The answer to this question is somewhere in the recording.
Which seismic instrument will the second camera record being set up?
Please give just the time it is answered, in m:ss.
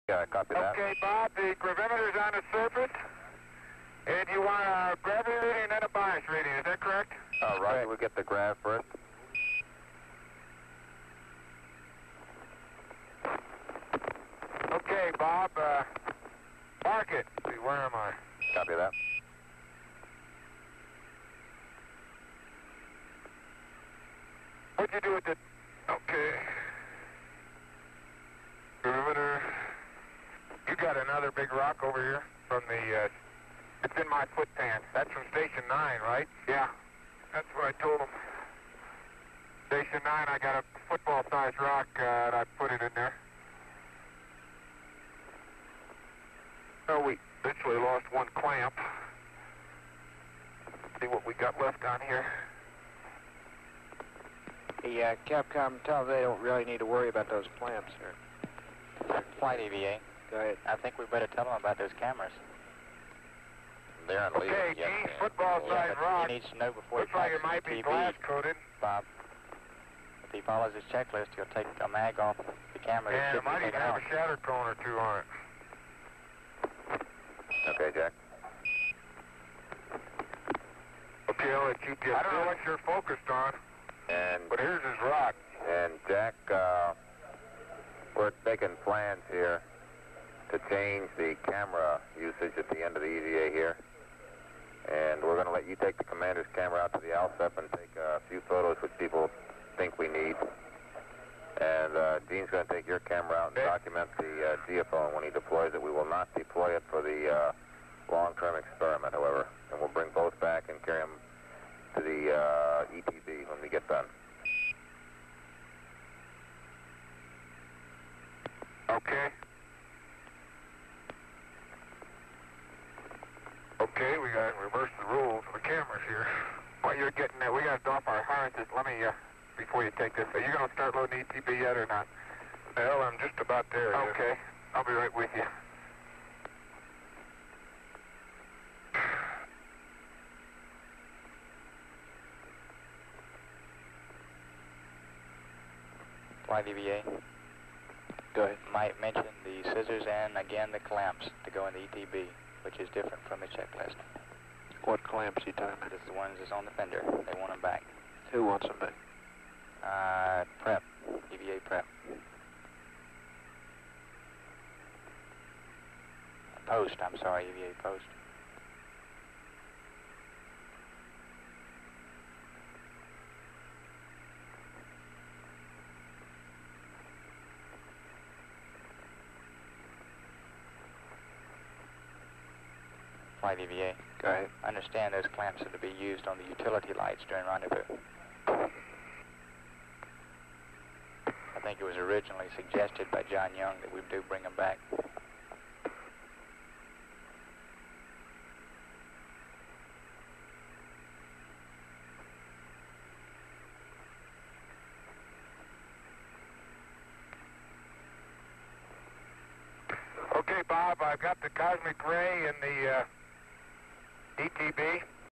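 1:44.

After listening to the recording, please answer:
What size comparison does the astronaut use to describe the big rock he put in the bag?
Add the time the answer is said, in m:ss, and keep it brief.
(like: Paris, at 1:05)
football-sized, at 0:40.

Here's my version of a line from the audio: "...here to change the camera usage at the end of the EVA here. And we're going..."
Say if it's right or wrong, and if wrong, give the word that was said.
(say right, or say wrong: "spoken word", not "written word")
right.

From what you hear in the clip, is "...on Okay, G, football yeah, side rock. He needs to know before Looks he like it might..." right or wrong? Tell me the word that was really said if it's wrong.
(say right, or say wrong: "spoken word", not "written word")
right.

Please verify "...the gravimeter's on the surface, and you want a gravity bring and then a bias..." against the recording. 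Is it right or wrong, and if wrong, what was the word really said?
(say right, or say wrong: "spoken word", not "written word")
wrong: "reading", not "bring".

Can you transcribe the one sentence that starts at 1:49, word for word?
And we'll bring both back and carry them to the uh, when we get done.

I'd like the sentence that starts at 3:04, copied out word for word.
I understand those clamps are to be used on the utility lights during rendezvous.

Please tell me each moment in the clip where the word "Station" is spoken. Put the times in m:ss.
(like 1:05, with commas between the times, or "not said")
0:35, 0:39.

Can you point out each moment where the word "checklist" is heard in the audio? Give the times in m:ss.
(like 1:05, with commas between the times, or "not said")
1:10, 2:33.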